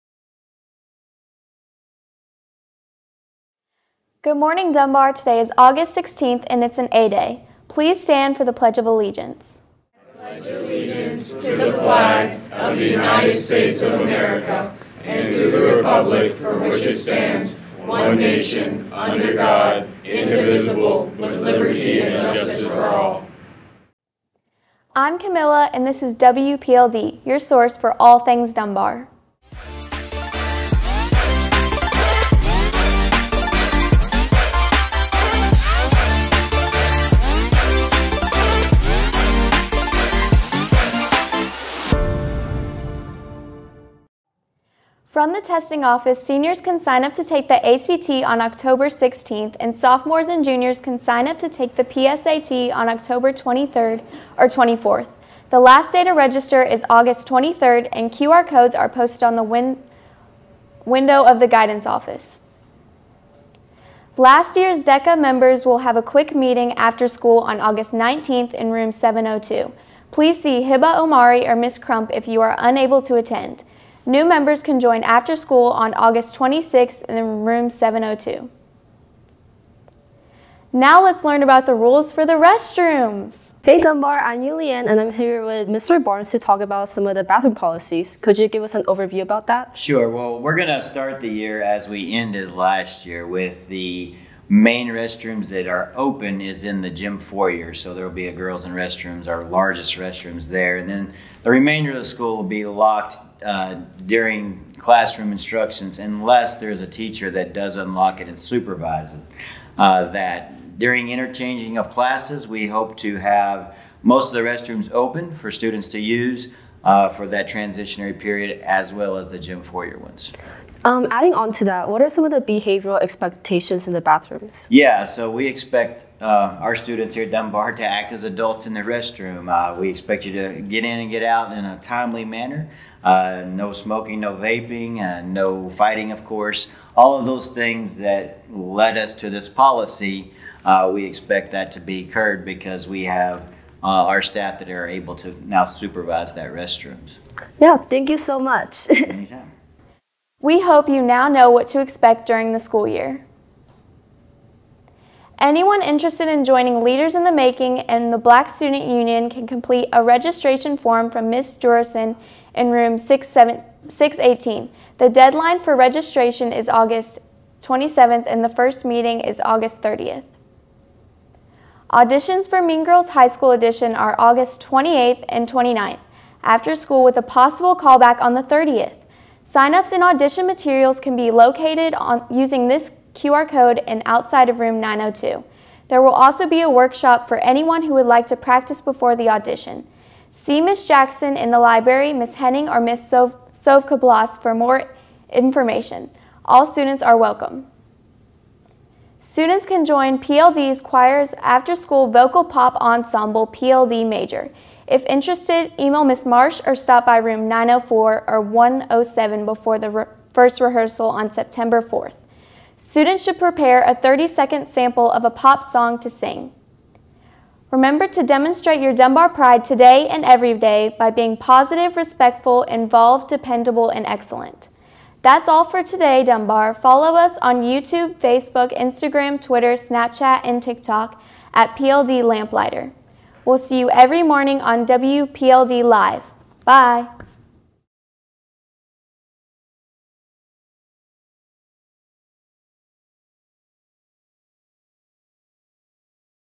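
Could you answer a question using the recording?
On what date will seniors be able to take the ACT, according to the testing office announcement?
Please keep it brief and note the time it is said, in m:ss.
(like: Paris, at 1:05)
October 16th, at 0:48.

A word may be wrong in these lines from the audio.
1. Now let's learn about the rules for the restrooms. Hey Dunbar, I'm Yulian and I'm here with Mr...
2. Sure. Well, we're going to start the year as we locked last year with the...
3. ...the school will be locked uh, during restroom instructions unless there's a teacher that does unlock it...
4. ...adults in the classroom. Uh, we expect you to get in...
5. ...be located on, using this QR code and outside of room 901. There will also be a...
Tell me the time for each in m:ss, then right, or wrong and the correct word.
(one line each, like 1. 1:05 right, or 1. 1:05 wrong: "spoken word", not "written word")
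1. 1:20 right
2. 1:29 wrong: "ended", not "locked"
3. 1:41 wrong: "classroom", not "restroom"
4. 2:08 wrong: "restroom", not "classroom"
5. 3:01 wrong: "902", not "901".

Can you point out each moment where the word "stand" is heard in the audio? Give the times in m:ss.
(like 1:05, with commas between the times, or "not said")
0:07, 0:16.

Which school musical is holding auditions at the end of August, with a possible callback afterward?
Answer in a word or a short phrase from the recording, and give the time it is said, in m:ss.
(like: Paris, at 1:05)
Mean Girls High School Edition, at 2:52.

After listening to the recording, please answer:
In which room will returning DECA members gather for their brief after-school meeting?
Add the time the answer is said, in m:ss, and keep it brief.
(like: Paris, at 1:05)
Room 702, at 1:08.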